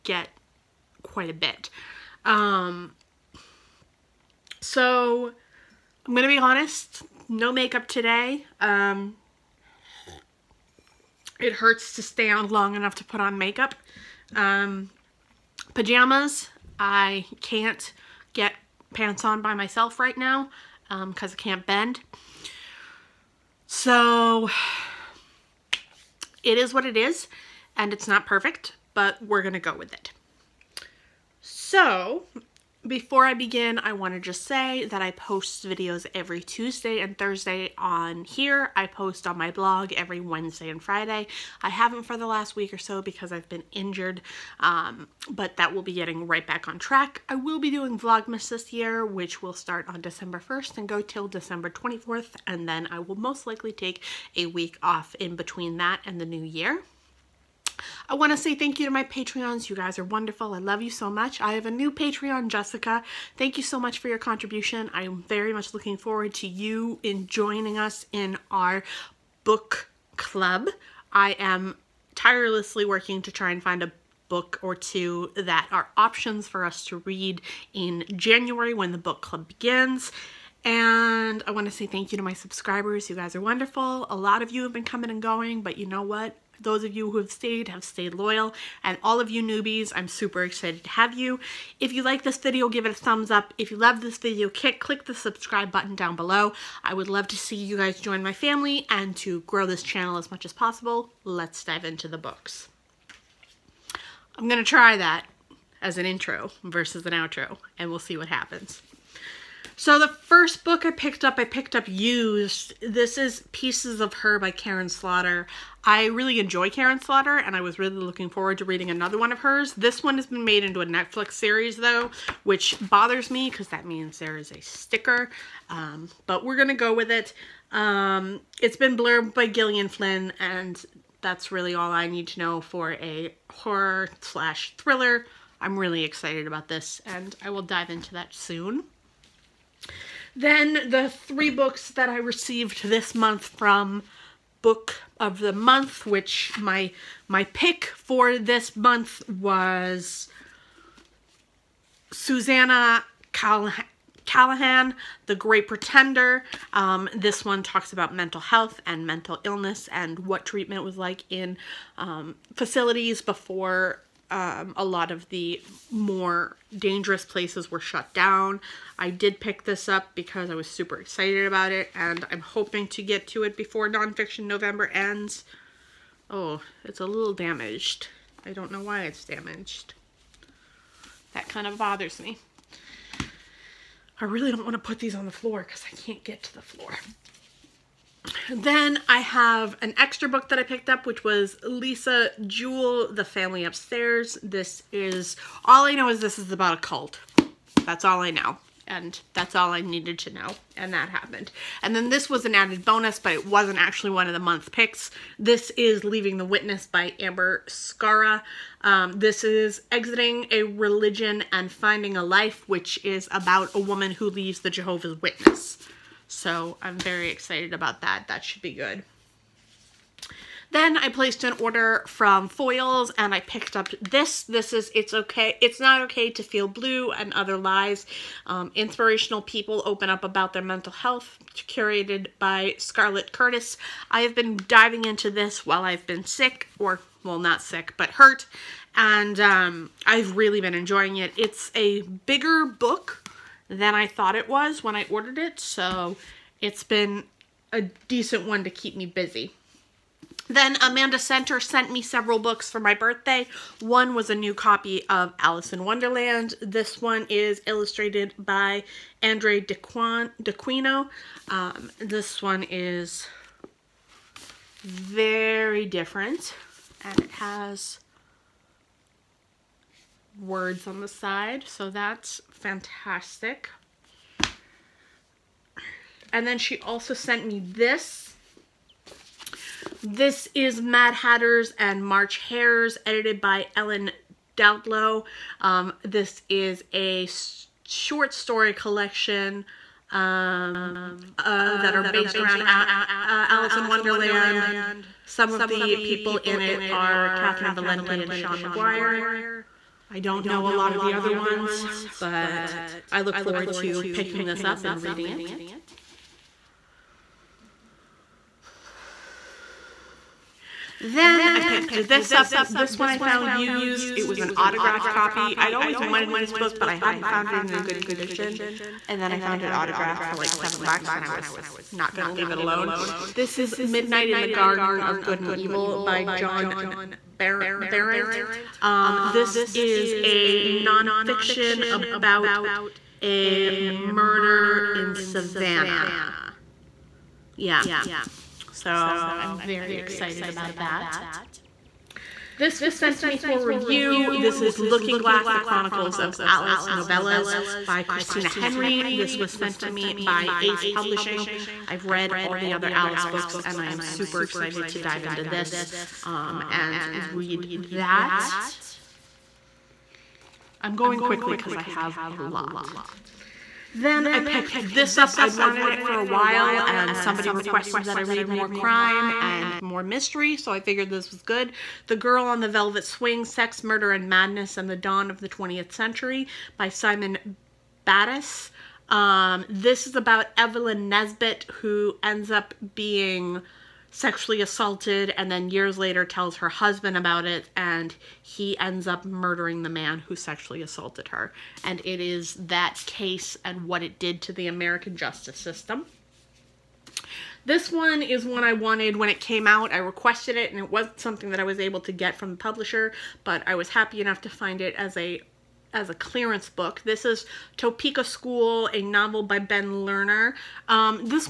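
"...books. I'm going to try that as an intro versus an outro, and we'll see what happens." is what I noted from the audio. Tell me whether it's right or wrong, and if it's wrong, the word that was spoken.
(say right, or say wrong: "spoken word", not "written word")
right.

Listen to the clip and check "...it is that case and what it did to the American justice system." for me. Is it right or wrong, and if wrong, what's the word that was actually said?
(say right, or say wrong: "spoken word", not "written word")
right.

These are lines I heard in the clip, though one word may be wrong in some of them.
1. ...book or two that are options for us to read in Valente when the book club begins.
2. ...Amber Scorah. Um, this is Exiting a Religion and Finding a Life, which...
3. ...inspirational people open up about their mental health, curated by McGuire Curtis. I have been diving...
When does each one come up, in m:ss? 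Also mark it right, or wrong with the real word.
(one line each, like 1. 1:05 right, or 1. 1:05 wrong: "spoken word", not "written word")
1. 1:14 wrong: "January", not "Valente"
2. 3:27 right
3. 3:48 wrong: "Scarlett", not "McGuire".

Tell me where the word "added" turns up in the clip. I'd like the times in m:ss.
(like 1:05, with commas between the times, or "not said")
3:22.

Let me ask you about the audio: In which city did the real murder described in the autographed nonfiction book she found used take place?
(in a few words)
Savannah.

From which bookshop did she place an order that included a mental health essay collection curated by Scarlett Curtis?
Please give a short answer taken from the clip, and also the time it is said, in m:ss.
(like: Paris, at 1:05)
Foyles, at 3:42.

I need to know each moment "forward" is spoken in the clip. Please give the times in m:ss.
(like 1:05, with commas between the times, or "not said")
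1:05, 1:58, 5:03.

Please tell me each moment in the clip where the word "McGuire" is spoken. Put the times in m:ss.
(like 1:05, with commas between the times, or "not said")
4:58.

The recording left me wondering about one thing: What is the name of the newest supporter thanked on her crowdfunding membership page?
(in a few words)
Jessica.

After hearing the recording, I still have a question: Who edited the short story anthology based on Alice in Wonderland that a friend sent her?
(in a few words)
Ellen Datlow.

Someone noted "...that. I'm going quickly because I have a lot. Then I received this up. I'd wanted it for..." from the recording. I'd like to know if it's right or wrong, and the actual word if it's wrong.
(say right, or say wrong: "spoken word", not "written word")
wrong: "picked", not "received".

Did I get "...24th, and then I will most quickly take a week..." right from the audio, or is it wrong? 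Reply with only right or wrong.
wrong.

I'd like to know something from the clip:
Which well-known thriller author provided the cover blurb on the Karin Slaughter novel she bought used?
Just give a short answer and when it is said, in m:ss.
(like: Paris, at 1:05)
Gillian Flynn, at 2:09.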